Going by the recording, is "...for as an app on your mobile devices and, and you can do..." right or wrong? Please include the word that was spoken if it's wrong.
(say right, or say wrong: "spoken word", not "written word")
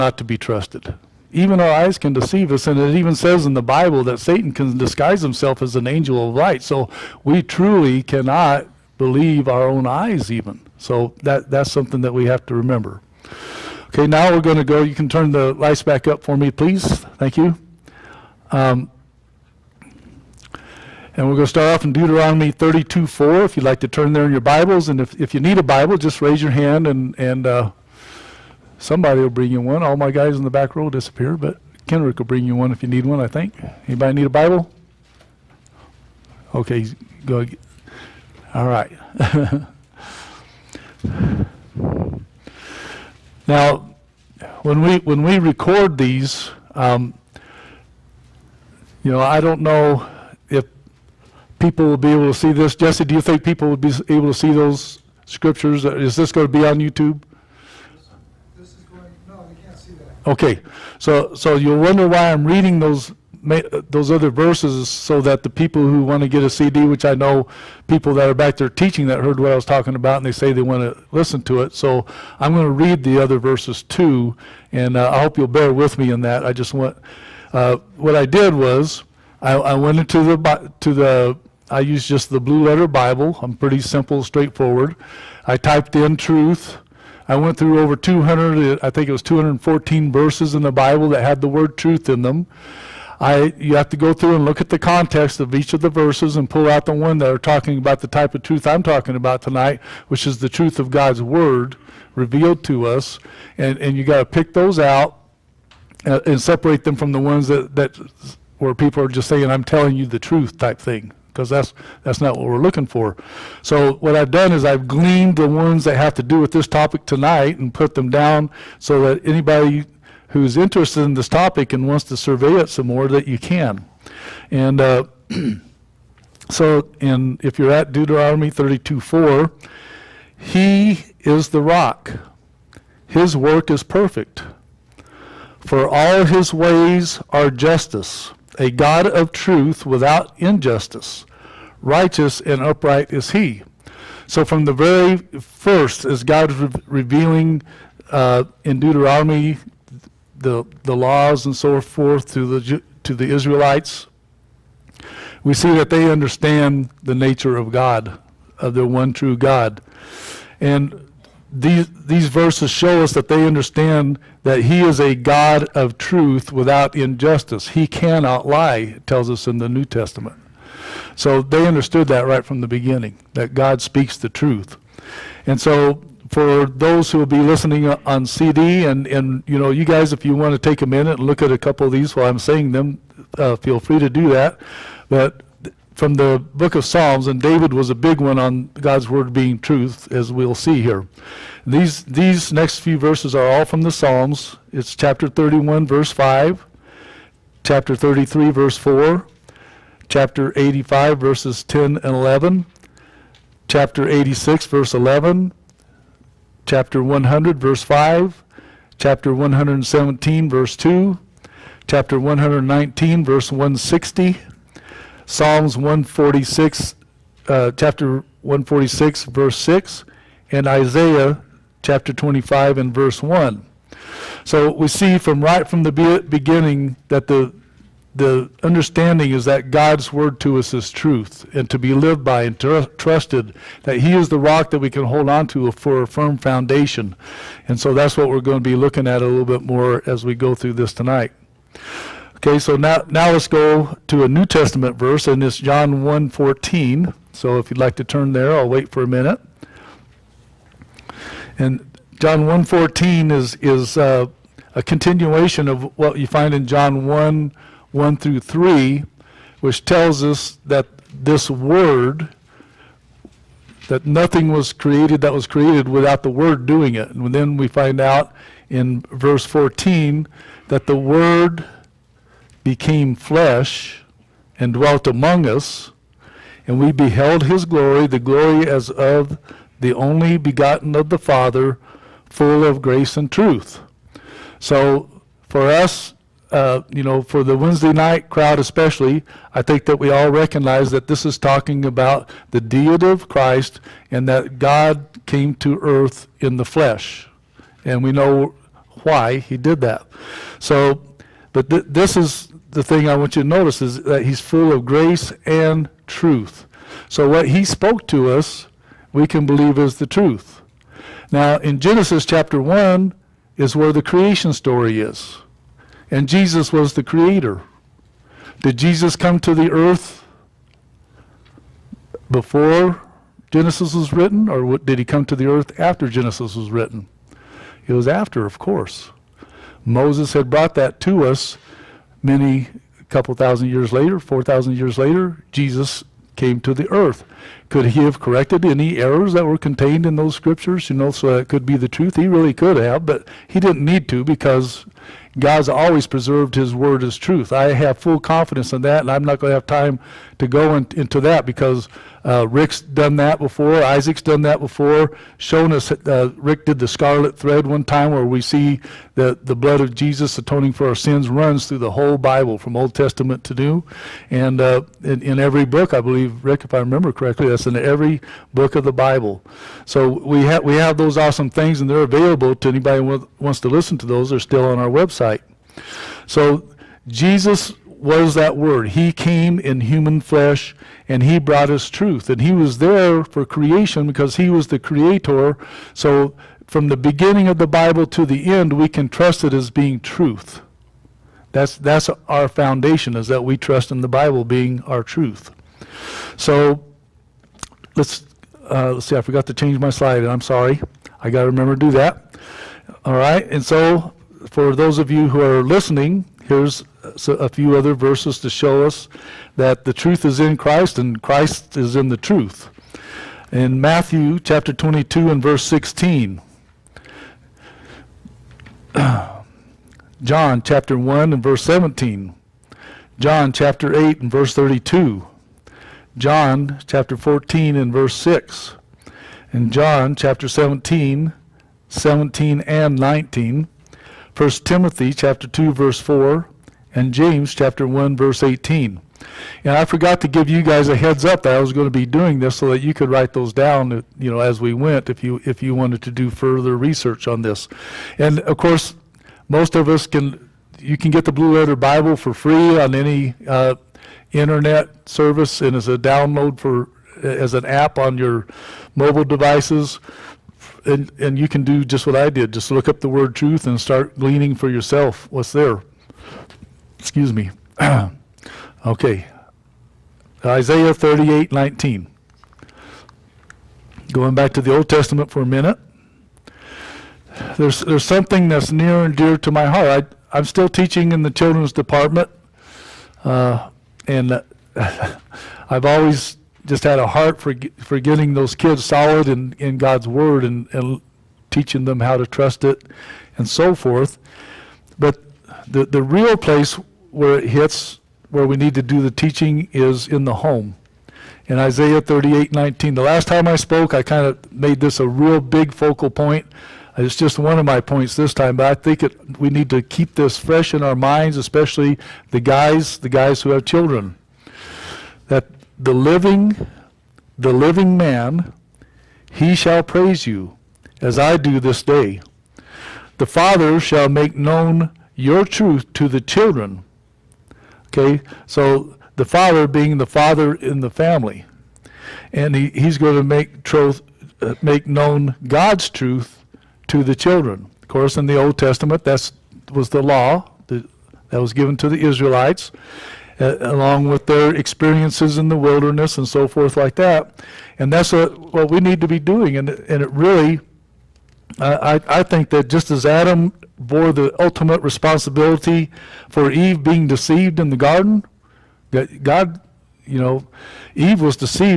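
right.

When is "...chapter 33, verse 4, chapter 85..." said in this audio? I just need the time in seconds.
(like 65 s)
197 s.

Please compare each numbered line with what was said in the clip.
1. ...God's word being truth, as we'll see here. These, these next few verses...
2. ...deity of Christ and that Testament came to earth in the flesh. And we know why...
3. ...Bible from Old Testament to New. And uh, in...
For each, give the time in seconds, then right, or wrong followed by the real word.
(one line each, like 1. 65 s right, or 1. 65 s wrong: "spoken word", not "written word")
1. 188 s right
2. 292 s wrong: "God", not "Testament"
3. 362 s right.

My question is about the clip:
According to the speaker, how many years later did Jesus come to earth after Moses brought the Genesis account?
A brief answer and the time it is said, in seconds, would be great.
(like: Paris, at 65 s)
4,000, at 334 s.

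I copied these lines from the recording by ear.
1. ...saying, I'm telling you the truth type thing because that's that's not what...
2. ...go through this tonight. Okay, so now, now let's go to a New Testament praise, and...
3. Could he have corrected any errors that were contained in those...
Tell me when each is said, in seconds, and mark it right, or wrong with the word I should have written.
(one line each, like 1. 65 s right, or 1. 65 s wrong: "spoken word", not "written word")
1. 109 s right
2. 240 s wrong: "verse", not "praise"
3. 337 s right.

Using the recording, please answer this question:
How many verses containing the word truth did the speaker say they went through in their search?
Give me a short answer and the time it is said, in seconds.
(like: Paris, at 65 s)
214, at 89 s.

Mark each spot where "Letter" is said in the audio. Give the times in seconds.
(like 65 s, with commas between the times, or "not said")
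82 s, 451 s.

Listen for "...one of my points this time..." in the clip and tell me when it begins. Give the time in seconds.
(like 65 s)
507 s.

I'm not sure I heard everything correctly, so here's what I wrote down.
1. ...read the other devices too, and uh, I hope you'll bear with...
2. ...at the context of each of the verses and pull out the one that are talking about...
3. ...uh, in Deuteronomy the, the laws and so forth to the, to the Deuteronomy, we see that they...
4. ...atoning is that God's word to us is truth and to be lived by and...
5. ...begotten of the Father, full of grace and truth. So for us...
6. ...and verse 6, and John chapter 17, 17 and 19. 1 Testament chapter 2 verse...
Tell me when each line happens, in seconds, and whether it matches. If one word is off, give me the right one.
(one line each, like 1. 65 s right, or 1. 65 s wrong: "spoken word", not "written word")
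1. 72 s wrong: "verses", not "devices"
2. 94 s right
3. 148 s wrong: "Israelites", not "Deuteronomy"
4. 228 s wrong: "understanding", not "atoning"
5. 280 s right
6. 427 s wrong: "Timothy", not "Testament".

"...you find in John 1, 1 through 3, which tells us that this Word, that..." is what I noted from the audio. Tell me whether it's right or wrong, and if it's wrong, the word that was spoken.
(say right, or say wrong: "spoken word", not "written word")
right.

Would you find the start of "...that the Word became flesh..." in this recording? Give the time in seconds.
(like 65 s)
270 s.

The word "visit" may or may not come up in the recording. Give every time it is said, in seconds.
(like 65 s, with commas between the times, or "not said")
not said.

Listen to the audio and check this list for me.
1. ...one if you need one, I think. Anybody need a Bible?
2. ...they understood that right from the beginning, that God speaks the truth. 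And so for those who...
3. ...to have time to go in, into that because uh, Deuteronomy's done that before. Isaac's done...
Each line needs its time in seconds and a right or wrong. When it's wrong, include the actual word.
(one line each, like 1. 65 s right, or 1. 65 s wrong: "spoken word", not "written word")
1. 32 s right
2. 171 s right
3. 349 s wrong: "Rick", not "Deuteronomy".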